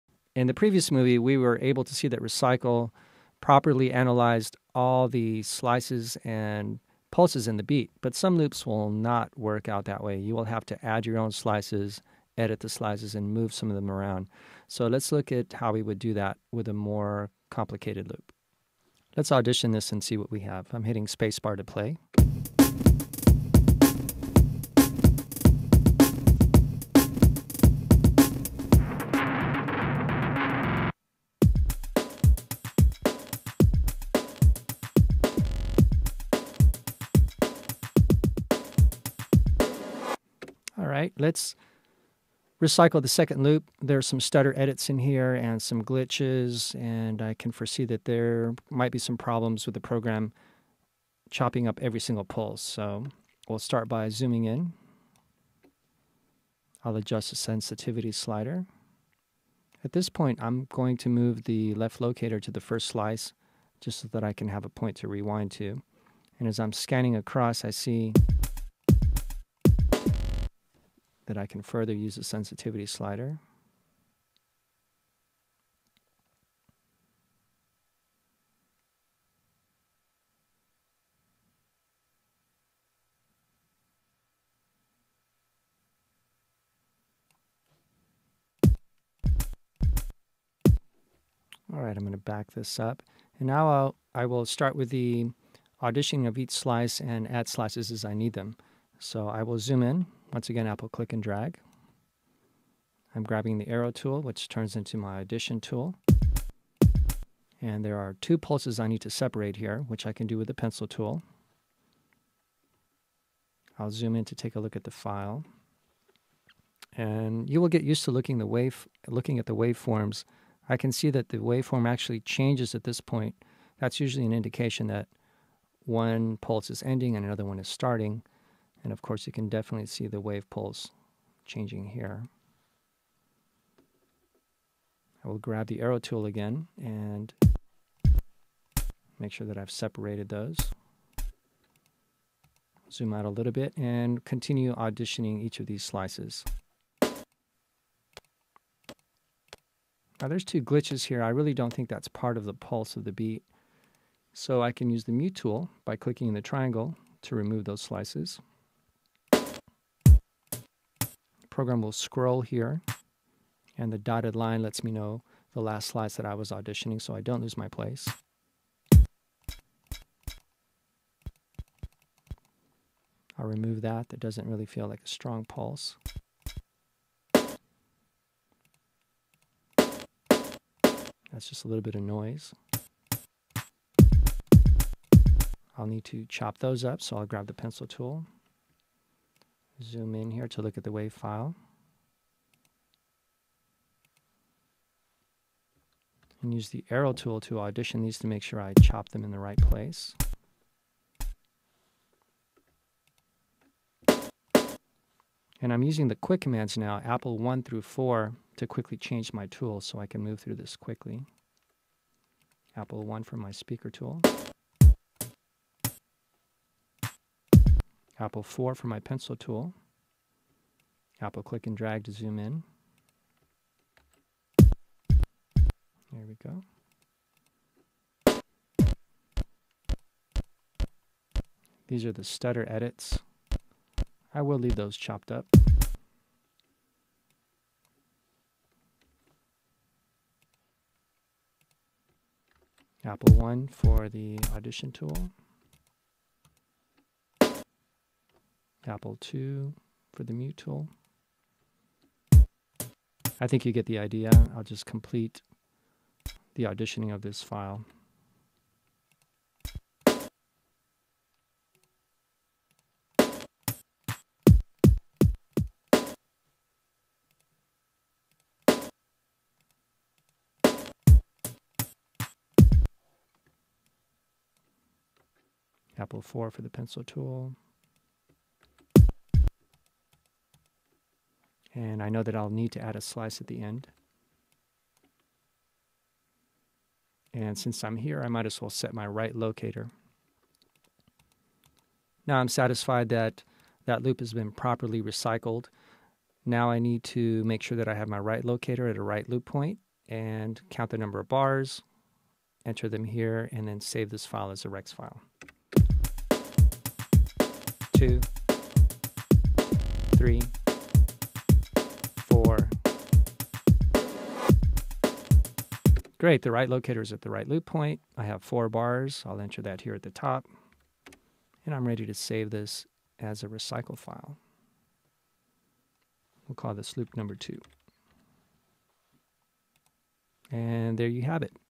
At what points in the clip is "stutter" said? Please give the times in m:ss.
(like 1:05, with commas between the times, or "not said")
0:44, 3:52.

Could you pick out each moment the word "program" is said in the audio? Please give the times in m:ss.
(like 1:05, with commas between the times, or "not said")
0:49, 2:41.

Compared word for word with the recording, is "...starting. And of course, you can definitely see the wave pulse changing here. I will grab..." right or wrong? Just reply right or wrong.
right.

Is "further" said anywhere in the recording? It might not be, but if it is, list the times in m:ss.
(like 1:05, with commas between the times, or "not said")
1:11.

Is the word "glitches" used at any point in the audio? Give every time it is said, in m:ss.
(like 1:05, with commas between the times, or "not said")
0:45, 2:30.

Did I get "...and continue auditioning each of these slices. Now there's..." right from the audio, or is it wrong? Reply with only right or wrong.
right.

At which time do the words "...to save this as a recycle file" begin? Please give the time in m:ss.
5:22.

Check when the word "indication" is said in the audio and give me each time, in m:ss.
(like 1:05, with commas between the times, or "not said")
2:04.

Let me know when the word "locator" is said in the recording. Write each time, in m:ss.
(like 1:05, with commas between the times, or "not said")
1:01, 4:49, 4:58, 5:16.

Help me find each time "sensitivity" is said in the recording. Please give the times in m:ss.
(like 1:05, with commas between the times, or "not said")
0:57, 1:12.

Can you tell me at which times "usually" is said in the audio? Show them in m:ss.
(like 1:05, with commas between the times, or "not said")
2:03.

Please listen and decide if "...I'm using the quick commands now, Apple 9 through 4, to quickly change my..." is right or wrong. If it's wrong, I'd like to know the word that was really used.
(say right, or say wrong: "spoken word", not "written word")
wrong: "1", not "9".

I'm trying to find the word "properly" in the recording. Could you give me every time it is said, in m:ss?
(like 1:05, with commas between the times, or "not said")
0:03, 4:54.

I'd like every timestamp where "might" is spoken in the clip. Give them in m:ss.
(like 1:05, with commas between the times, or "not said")
0:48, 4:48.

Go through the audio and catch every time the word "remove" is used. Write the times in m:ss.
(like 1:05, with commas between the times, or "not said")
2:37, 2:53.